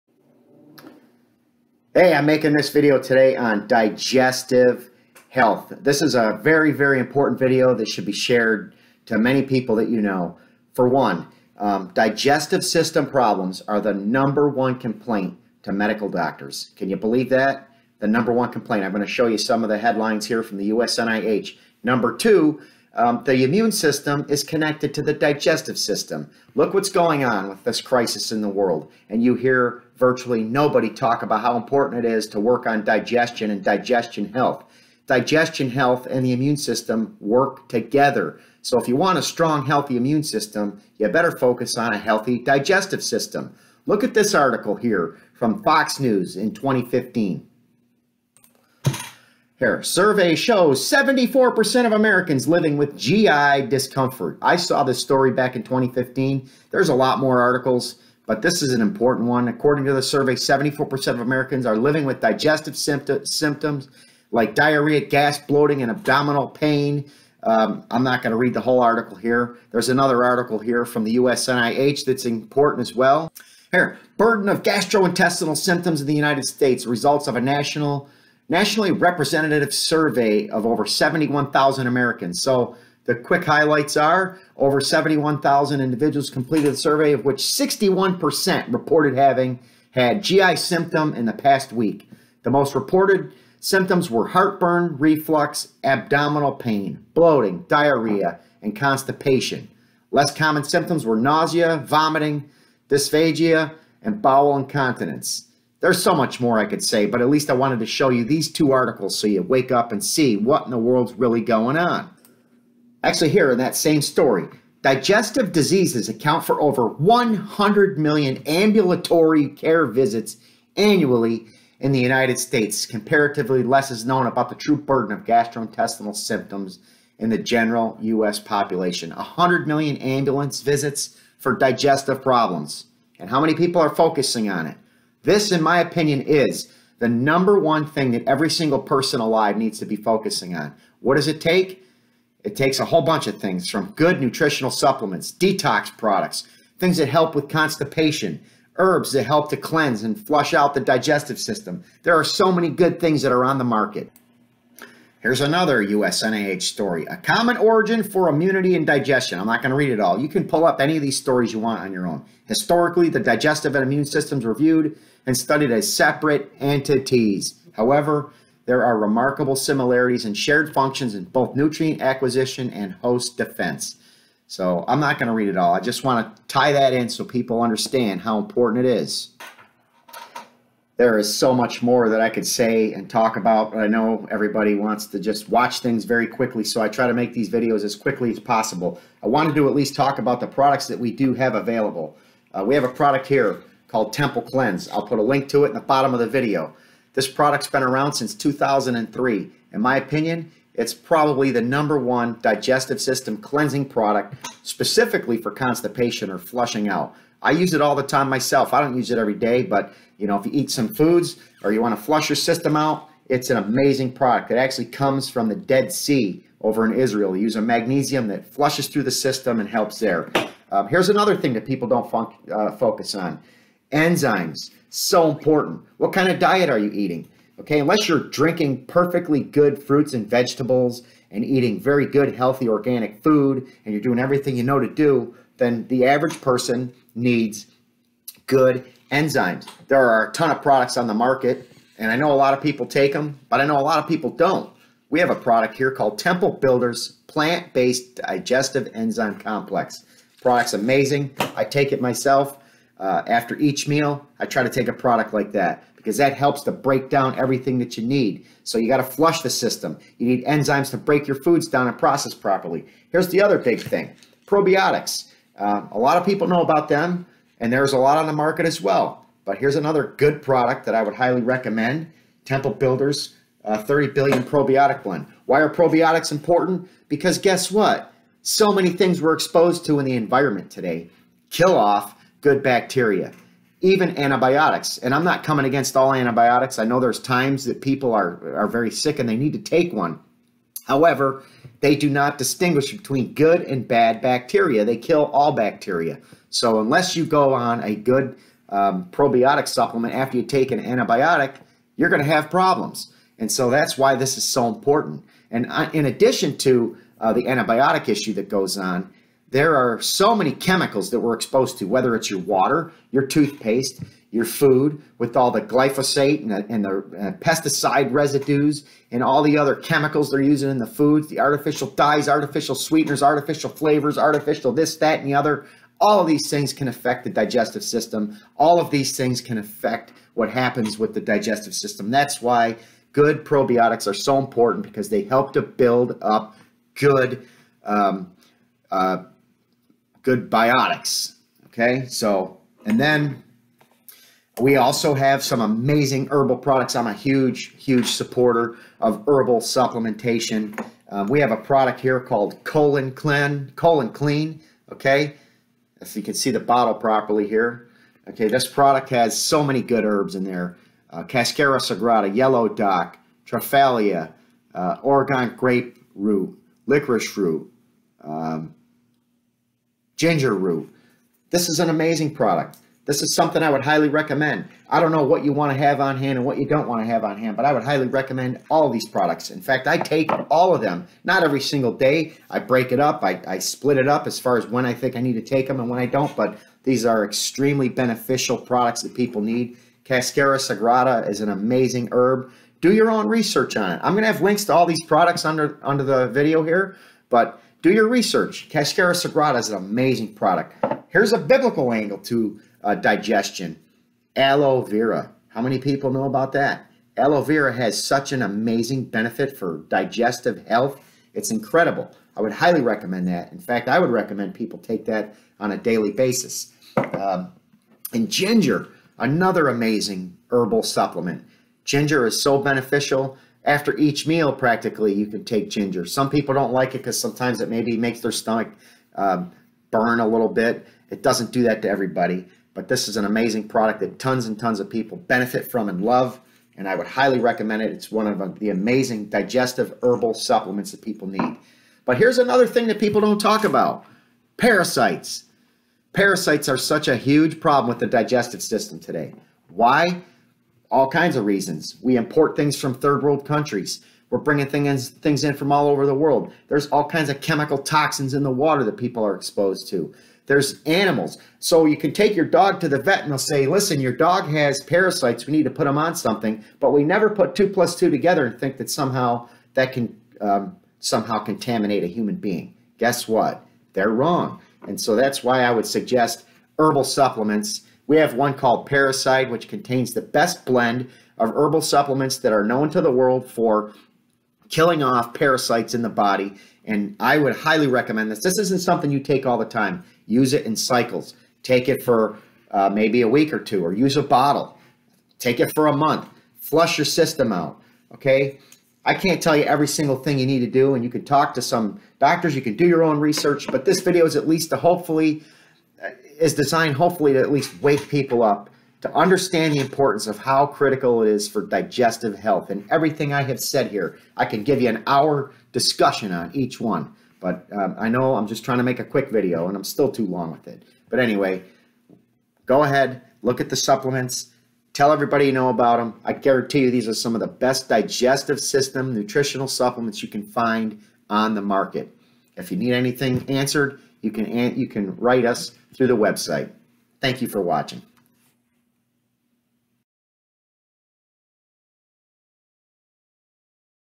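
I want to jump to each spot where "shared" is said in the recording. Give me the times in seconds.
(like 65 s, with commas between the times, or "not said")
8 s, 170 s.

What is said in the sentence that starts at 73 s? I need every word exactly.
Here, burden of gastrointestinal symptoms in the United States, results of a national nationally representative survey of over 71,000 Americans.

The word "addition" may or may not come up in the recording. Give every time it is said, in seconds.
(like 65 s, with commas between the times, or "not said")
306 s.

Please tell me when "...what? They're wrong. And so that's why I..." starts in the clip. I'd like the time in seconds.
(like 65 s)
473 s.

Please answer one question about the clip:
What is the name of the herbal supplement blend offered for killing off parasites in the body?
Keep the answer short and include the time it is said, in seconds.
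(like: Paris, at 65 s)
Paracide, at 478 s.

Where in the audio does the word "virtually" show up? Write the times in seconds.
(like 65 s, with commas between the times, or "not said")
29 s.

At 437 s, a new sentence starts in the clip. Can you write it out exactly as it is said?
It's one of uh, the amazing digestive herbal supplements that people need.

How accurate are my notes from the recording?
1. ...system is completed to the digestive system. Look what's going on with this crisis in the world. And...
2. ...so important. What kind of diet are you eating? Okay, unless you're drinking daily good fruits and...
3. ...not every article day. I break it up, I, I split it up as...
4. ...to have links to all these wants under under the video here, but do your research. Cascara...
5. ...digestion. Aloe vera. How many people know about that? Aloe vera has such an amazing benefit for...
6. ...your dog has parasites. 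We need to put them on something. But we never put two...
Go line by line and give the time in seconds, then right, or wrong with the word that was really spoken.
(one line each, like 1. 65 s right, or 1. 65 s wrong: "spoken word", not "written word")
1. 23 s wrong: "connected", not "completed"
2. 224 s wrong: "perfectly", not "daily"
3. 381 s wrong: "single", not "article"
4. 394 s wrong: "products", not "wants"
5. 402 s right
6. 464 s right.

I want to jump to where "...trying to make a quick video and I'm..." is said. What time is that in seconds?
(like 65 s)
518 s.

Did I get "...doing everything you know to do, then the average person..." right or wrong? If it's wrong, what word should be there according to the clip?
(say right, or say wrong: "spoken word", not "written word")
right.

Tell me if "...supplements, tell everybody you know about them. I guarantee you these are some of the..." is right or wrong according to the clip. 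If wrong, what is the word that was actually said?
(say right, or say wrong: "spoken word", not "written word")
right.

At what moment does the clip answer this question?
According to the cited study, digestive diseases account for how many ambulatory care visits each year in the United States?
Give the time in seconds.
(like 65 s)
116 s.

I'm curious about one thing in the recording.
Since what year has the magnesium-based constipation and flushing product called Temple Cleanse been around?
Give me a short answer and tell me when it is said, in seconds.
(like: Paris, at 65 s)
2003, at 198 s.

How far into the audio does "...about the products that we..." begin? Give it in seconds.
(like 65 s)
190 s.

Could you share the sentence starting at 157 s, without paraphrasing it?
A common origin for immunity and digestion.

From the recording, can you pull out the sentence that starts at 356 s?
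If you can see the bottle properly here.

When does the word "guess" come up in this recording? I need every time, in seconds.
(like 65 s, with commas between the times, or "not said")
277 s, 472 s.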